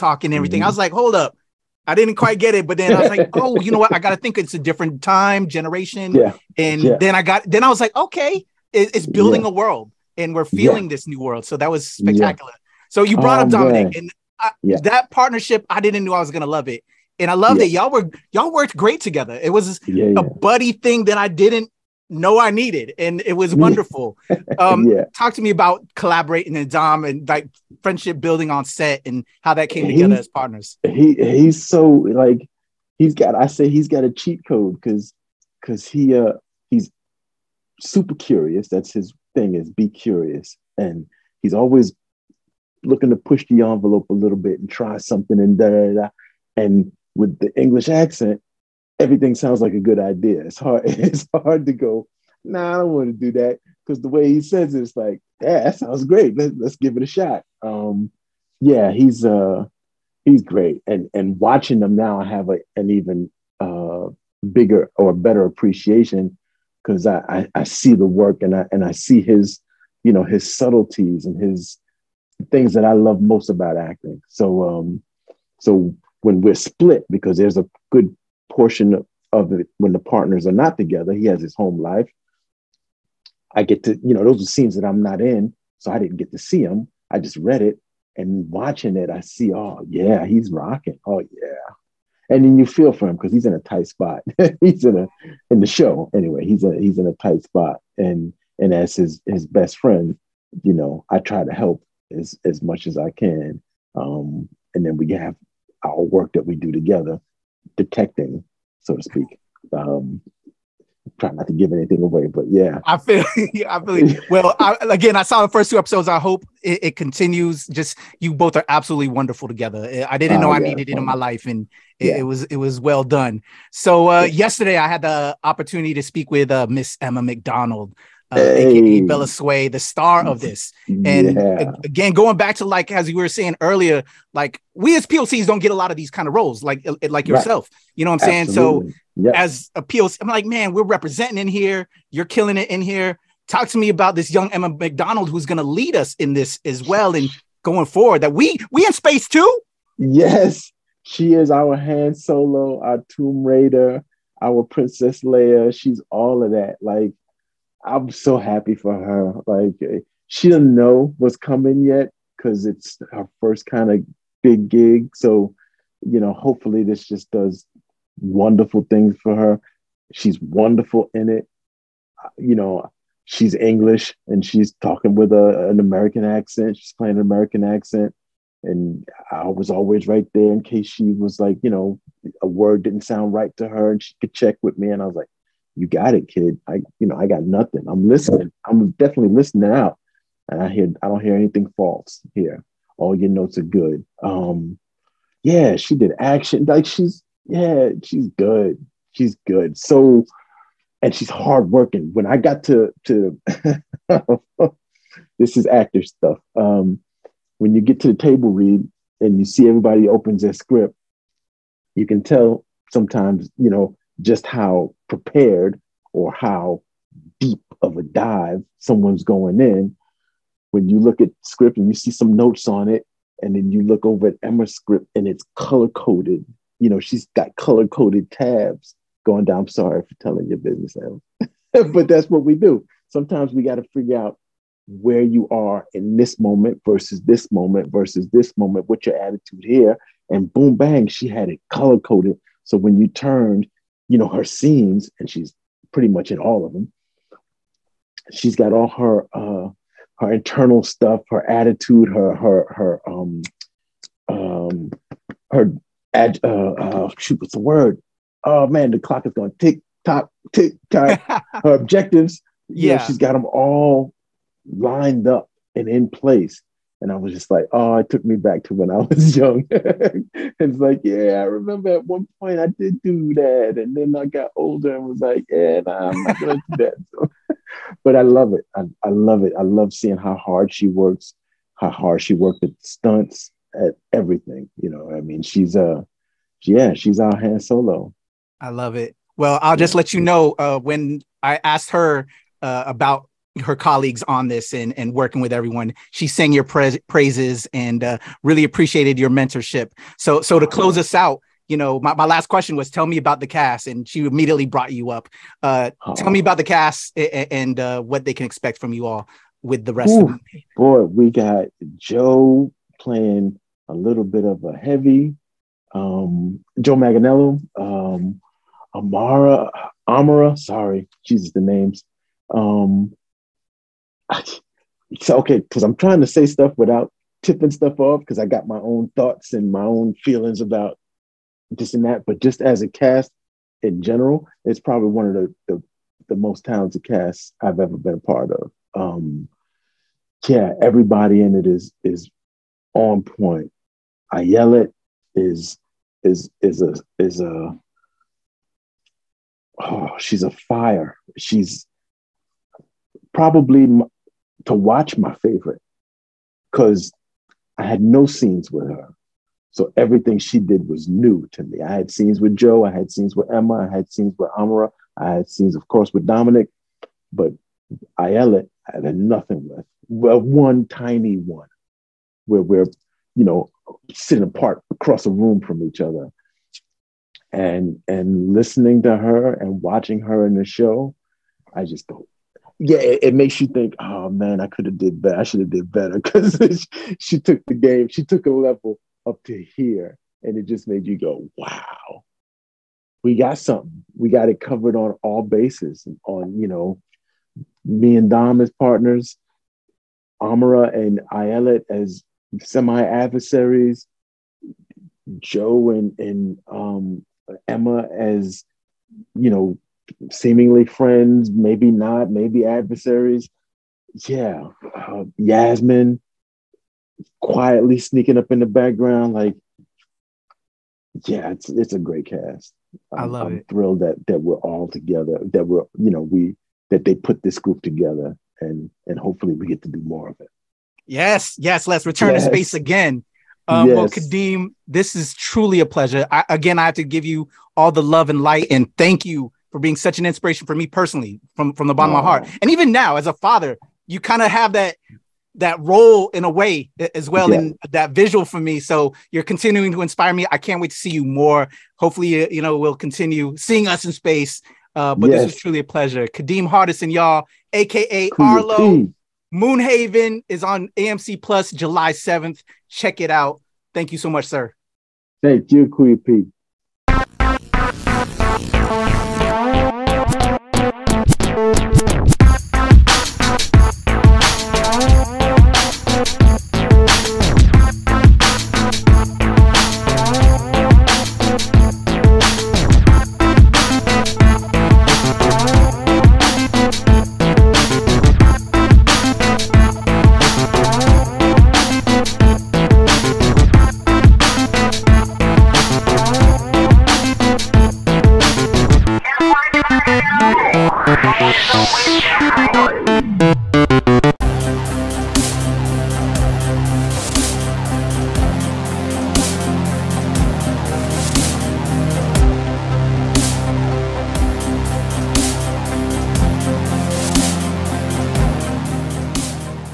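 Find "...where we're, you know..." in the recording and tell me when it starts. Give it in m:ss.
6:12.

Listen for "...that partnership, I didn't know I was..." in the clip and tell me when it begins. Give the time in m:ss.
0:14.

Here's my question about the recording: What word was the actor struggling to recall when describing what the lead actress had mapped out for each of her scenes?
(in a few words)
Objectives.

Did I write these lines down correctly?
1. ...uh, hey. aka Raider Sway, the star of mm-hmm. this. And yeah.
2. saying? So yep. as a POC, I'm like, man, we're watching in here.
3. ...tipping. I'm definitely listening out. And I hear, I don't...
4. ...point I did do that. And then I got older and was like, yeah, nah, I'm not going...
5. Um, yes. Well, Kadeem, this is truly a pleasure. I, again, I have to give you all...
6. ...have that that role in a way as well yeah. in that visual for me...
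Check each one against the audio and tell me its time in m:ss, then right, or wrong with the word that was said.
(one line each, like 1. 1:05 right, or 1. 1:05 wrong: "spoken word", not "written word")
1. 2:08 wrong: "Bella", not "Raider"
2. 2:18 wrong: "representing", not "watching"
3. 3:08 wrong: "listening", not "tipping"
4. 4:32 right
5. 7:13 right
6. 7:24 right.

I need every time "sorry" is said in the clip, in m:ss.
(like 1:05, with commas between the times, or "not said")
3:49, 5:20.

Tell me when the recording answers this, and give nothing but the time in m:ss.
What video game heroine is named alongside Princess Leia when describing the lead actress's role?
2:33.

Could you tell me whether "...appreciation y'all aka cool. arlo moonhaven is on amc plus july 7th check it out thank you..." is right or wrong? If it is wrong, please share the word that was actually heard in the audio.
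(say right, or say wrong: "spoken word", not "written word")
wrong: "hardison", not "appreciation".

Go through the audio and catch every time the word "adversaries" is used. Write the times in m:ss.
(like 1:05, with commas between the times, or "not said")
6:43, 6:52.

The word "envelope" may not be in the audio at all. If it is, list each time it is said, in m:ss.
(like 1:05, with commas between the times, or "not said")
0:43.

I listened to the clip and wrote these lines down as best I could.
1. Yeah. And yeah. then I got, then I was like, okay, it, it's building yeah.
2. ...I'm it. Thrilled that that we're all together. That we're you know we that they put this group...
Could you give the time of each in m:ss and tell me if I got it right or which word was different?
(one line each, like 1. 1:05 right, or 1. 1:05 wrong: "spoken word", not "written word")
1. 0:06 right
2. 7:03 right.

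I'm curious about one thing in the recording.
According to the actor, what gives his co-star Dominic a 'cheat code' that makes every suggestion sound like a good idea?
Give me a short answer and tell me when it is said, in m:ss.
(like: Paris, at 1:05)
English accent, at 0:47.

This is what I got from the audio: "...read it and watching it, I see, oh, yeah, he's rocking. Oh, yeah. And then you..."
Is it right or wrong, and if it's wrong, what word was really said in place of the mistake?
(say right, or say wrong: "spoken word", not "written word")
right.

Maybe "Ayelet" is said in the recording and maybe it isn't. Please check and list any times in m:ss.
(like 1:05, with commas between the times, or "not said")
5:44, 6:41.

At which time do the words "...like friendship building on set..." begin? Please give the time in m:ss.
0:27.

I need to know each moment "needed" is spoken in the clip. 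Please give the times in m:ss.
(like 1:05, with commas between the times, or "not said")
0:22, 2:00.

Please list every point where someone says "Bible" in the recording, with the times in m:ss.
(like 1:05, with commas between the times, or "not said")
not said.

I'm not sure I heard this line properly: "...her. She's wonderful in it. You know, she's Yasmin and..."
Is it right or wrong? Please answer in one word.
wrong.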